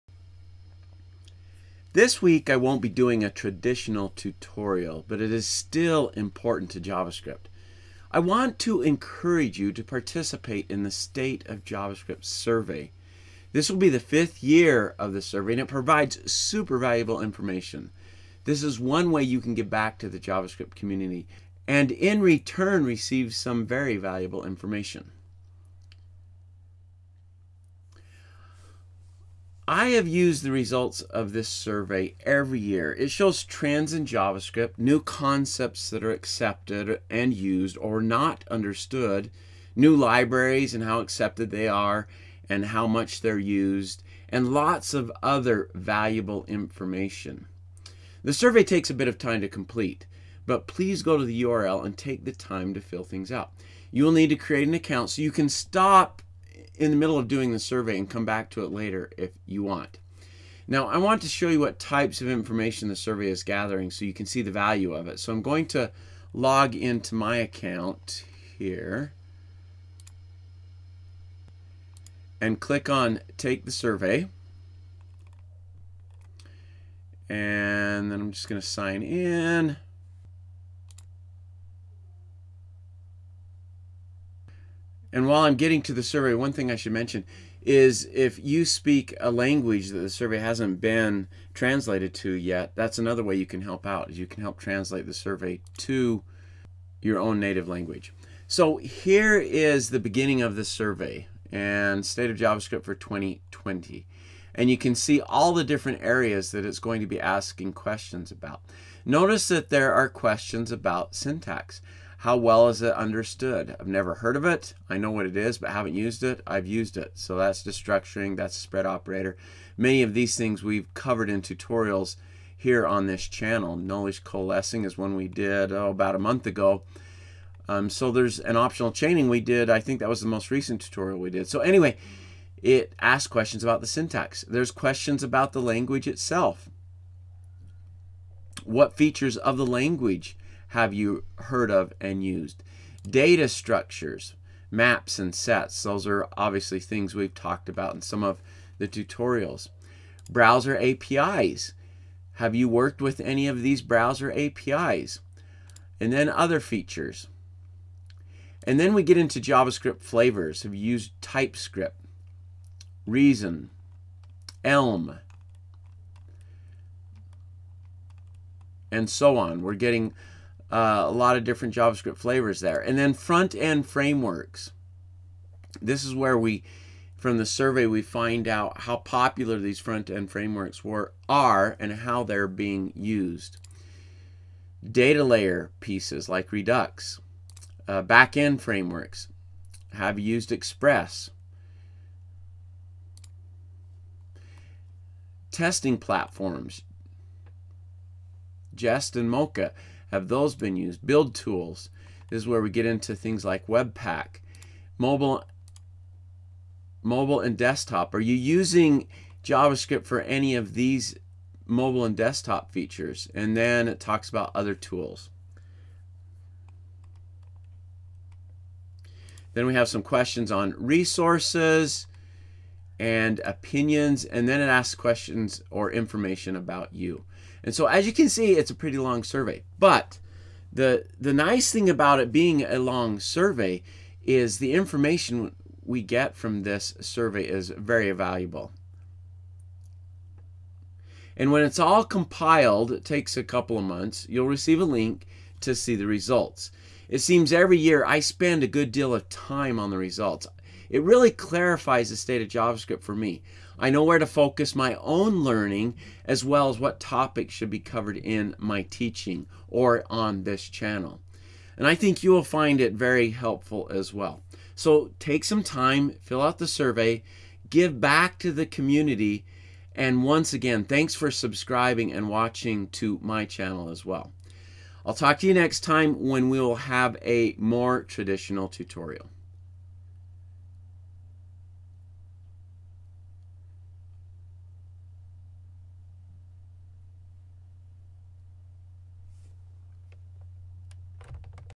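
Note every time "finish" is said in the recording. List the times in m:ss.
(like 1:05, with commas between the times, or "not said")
not said.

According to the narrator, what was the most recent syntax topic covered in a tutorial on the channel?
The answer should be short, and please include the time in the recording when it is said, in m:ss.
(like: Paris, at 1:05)
optional chaining, at 2:08.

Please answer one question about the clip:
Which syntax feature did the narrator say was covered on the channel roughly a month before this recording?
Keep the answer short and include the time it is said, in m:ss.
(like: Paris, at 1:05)
Nullish coalescing, at 2:03.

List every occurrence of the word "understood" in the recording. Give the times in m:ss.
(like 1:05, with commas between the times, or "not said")
0:38, 1:52.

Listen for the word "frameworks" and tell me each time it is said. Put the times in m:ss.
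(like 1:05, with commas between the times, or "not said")
2:53, 3:00, 3:08.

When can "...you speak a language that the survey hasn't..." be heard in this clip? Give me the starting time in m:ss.
1:28.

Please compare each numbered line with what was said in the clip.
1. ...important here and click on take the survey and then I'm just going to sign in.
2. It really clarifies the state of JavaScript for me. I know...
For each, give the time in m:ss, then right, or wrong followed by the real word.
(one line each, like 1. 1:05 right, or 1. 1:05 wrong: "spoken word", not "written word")
1. 1:07 wrong: "account", not "important"
2. 4:10 right.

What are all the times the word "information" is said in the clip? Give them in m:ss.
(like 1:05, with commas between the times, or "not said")
0:17, 0:24, 0:46, 1:02, 3:45, 3:54.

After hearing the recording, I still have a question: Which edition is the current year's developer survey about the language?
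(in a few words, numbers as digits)
fifth.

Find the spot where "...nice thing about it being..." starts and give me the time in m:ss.
3:51.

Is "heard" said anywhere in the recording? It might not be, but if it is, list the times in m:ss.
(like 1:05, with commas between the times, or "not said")
1:54, 2:21.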